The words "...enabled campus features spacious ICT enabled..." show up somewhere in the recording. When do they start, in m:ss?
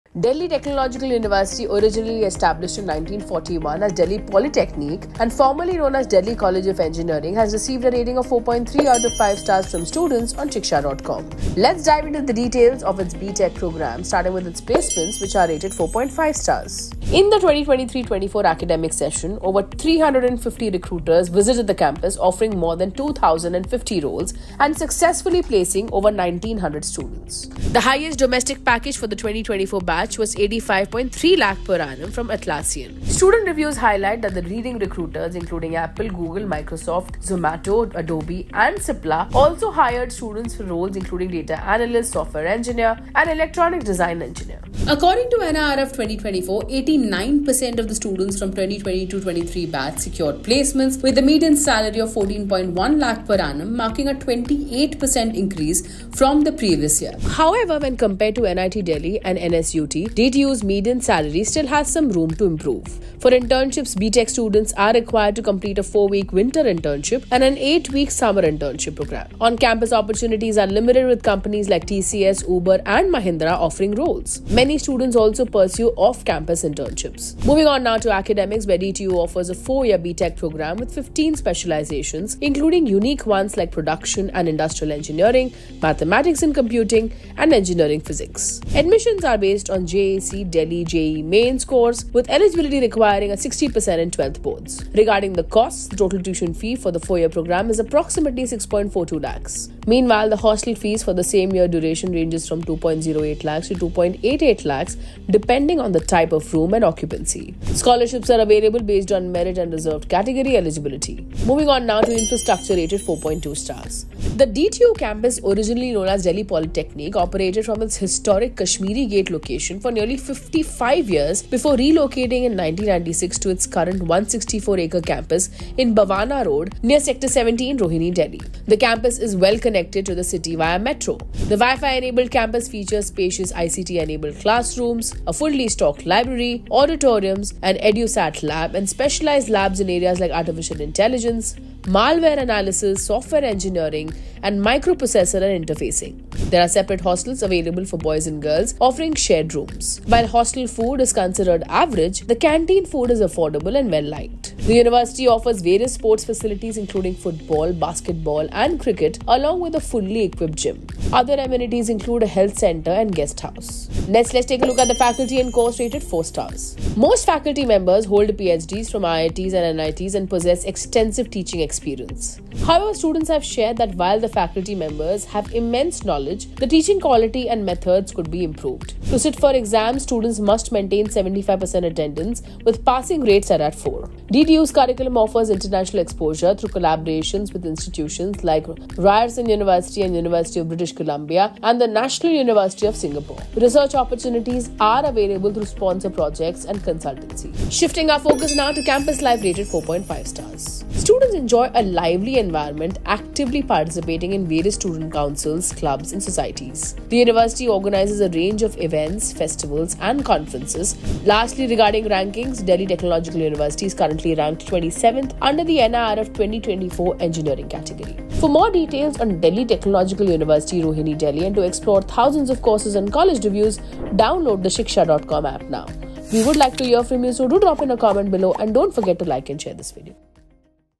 2:11.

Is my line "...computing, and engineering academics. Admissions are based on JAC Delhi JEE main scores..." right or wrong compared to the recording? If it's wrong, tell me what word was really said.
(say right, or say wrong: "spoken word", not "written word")
wrong: "physics", not "academics".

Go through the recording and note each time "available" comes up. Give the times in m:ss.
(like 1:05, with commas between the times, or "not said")
1:48, 2:27, 3:15.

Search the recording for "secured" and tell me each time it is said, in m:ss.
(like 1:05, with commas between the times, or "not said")
0:49.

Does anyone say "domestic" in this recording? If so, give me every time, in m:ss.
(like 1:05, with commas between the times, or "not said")
0:28.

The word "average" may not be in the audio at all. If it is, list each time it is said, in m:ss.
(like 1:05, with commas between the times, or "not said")
2:31.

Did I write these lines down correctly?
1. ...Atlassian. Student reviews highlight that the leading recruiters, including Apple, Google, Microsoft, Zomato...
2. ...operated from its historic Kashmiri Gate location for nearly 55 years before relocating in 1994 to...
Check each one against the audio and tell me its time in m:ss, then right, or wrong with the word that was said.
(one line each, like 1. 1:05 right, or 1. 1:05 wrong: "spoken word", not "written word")
1. 0:32 right
2. 1:57 wrong: "1996", not "1994".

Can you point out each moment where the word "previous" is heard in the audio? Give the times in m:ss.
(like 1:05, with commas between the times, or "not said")
0:56.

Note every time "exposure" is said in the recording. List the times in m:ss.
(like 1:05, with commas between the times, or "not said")
3:06.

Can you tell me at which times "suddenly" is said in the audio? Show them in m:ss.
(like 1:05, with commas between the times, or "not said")
not said.